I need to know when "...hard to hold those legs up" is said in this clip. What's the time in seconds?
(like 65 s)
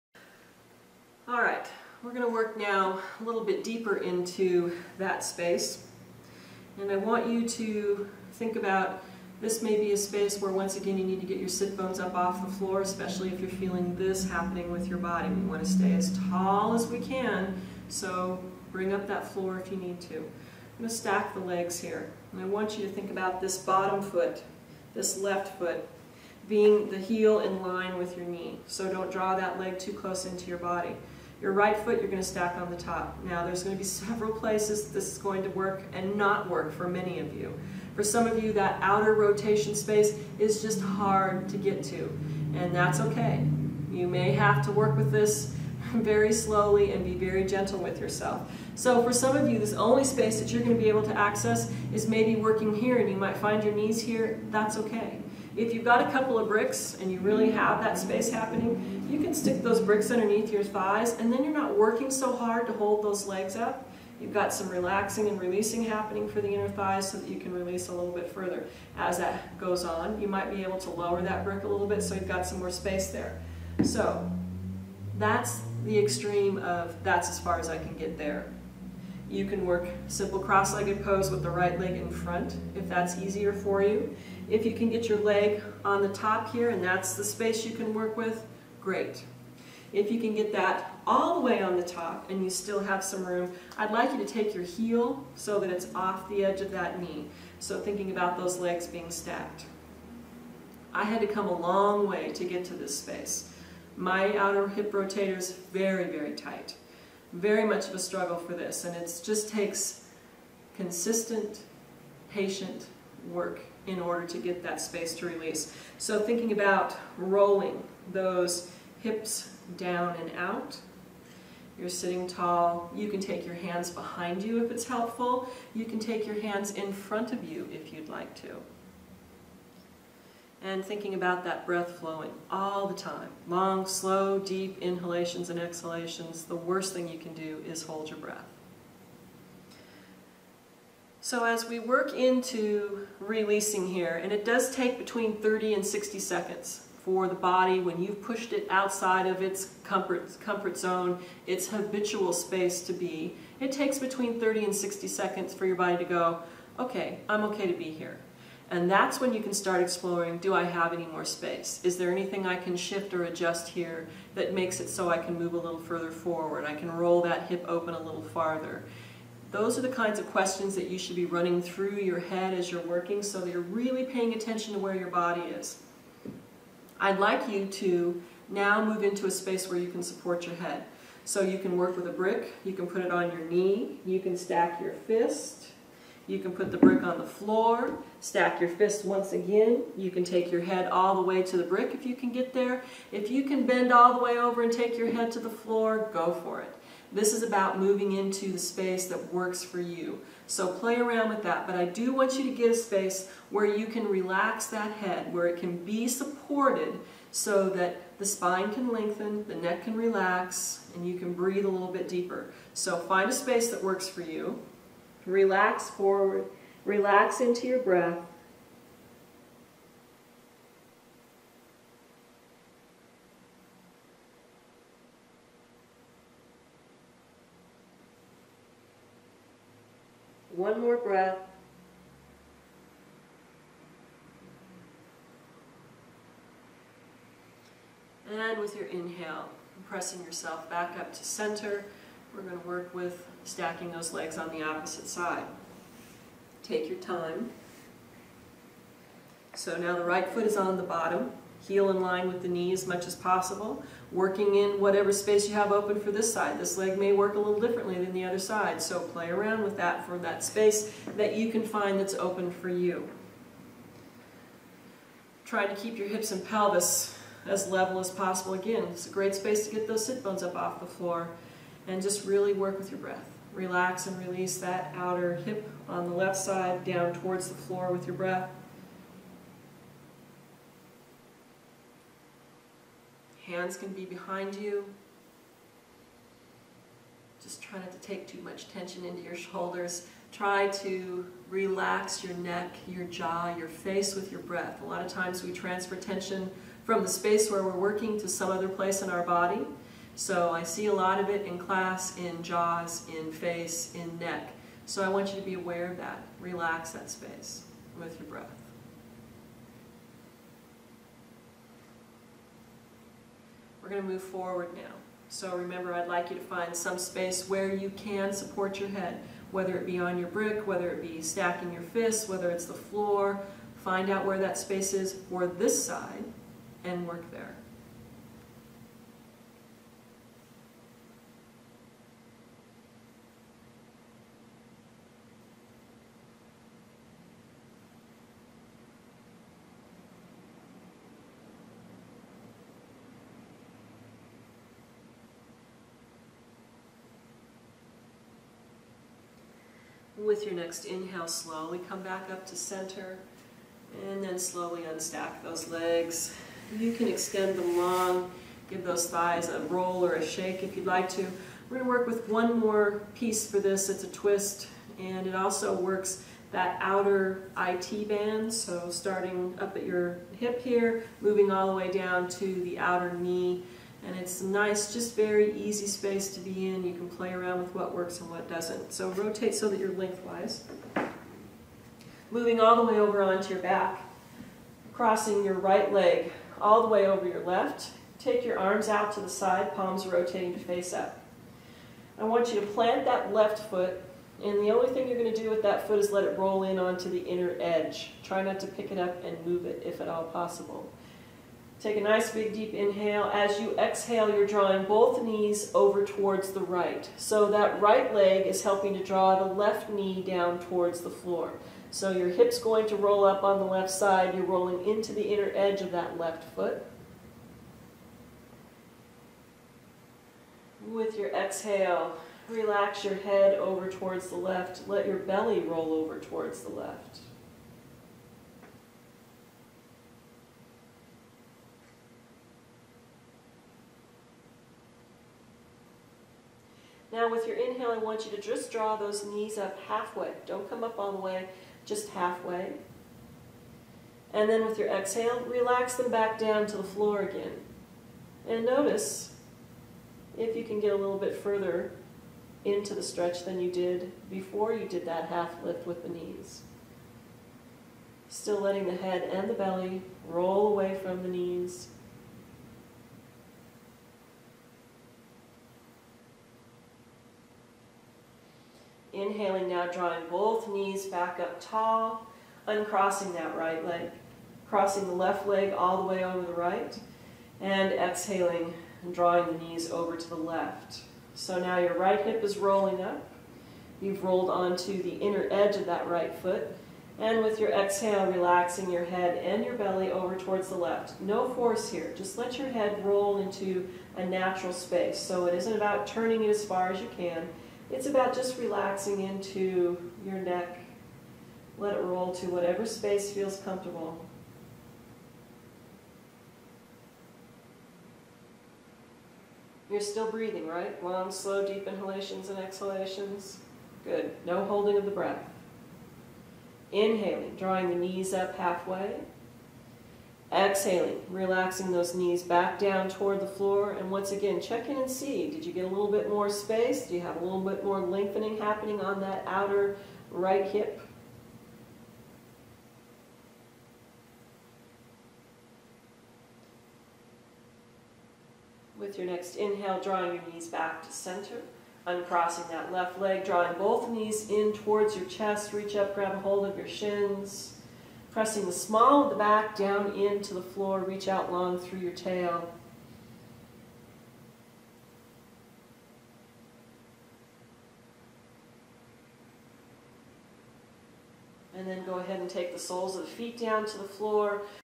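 62 s.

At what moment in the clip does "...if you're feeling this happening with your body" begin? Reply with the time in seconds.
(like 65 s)
13 s.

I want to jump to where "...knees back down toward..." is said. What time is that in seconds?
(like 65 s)
522 s.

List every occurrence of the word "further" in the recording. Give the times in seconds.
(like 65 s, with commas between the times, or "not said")
68 s, 165 s, 451 s.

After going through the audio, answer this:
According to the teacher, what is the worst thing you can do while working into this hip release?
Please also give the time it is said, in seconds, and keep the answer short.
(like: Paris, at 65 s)
Hold your breath, at 137 s.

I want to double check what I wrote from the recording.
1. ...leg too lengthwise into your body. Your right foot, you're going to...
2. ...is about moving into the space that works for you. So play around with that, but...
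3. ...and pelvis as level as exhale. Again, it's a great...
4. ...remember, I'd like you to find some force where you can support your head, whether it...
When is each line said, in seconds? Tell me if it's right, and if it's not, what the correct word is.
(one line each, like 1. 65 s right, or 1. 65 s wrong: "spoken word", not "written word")
1. 29 s wrong: "close", not "lengthwise"
2. 197 s right
3. 266 s wrong: "possible", not "exhale"
4. 315 s wrong: "space", not "force".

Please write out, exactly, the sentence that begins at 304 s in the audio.
So I want you to be aware of that.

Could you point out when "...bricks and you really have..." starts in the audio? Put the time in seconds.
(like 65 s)
56 s.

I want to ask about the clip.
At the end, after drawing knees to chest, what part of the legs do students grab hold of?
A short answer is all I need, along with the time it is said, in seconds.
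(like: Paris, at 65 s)
Shins, at 546 s.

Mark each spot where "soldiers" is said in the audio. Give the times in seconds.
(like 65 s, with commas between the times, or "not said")
not said.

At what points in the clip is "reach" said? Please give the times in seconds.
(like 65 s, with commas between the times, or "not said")
545 s, 551 s.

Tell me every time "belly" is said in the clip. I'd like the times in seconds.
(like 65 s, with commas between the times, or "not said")
425 s, 459 s, 489 s.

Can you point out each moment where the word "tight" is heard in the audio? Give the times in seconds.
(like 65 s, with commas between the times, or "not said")
106 s.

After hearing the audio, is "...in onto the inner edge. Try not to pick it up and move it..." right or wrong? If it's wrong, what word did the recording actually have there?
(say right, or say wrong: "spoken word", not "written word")
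right.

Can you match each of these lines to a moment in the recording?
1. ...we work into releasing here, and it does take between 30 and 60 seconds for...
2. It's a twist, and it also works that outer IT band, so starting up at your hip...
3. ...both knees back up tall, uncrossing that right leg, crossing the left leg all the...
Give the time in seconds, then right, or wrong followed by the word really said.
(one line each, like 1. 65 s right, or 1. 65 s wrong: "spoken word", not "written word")
1. 141 s right
2. 363 s right
3. 470 s right.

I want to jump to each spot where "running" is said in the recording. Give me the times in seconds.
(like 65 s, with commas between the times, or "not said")
171 s.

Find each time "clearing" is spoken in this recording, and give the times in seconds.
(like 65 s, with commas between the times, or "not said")
not said.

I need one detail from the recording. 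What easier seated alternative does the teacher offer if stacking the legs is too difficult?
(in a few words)
Simple cross-legged pose.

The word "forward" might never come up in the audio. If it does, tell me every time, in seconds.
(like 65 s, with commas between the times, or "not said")
166 s, 215 s, 314 s.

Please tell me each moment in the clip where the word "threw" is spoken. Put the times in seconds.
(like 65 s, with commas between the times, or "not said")
not said.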